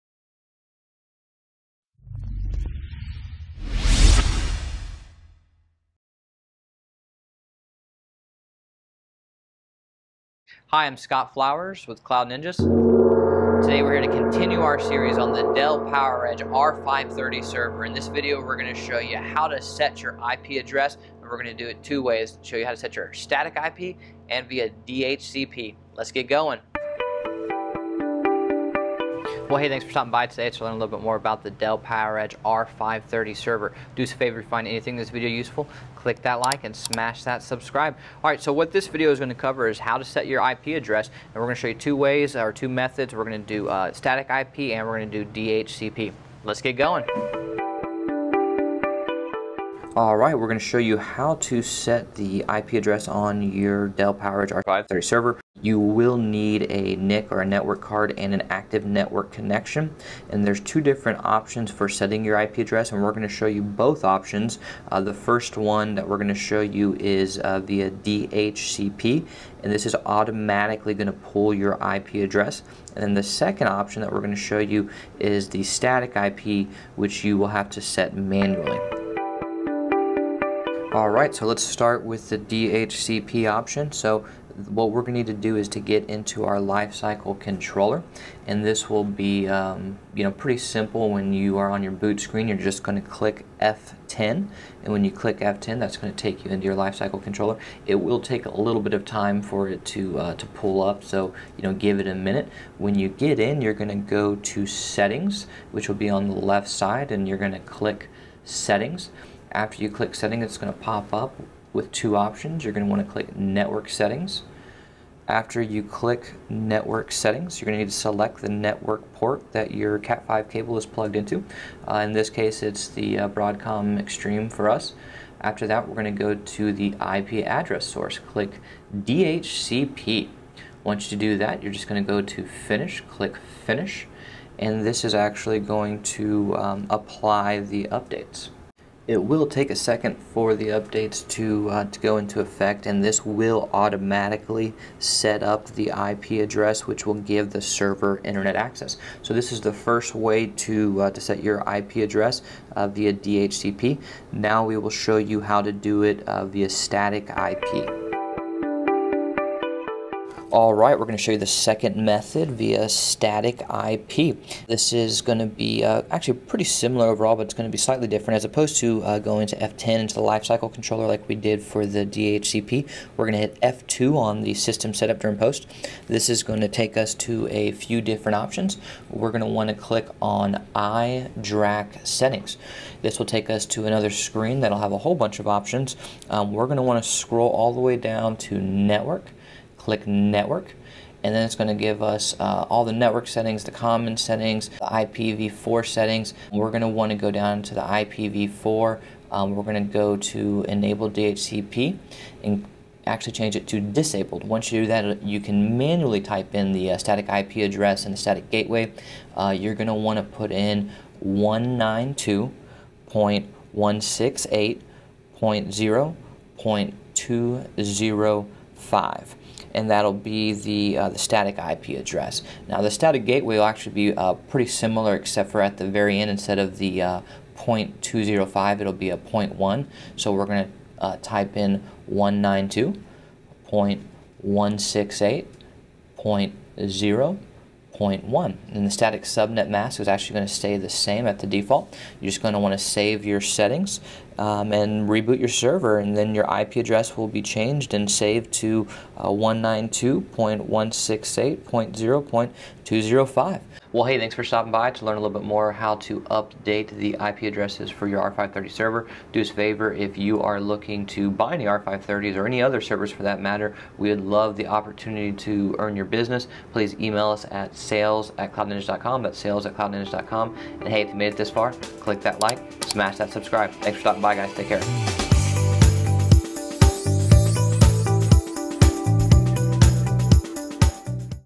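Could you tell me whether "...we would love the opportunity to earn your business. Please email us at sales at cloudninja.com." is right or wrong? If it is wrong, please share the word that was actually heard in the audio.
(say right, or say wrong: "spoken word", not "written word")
right.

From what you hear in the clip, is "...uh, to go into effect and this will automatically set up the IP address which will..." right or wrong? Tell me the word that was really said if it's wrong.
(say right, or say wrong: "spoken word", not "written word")
right.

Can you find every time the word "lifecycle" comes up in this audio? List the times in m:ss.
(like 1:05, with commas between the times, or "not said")
1:26, 1:36, 2:50.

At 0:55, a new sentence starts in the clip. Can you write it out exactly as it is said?
You will need a NIC or a network card and an active network connection.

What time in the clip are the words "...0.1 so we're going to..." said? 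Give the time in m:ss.
3:49.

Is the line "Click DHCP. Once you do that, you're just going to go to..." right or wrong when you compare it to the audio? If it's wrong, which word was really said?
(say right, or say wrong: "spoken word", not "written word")
right.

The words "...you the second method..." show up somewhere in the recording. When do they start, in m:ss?
2:41.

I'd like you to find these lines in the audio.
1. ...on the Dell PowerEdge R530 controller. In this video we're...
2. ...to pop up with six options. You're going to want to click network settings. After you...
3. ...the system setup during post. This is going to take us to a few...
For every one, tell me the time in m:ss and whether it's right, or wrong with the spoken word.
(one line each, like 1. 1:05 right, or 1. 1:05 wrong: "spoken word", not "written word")
1. 0:15 wrong: "server", not "controller"
2. 1:50 wrong: "two", not "six"
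3. 2:54 right.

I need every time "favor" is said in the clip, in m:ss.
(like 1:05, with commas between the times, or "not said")
0:34, 4:19.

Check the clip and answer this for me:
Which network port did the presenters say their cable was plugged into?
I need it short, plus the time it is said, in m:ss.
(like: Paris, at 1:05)
Broadcom Extreme, at 2:03.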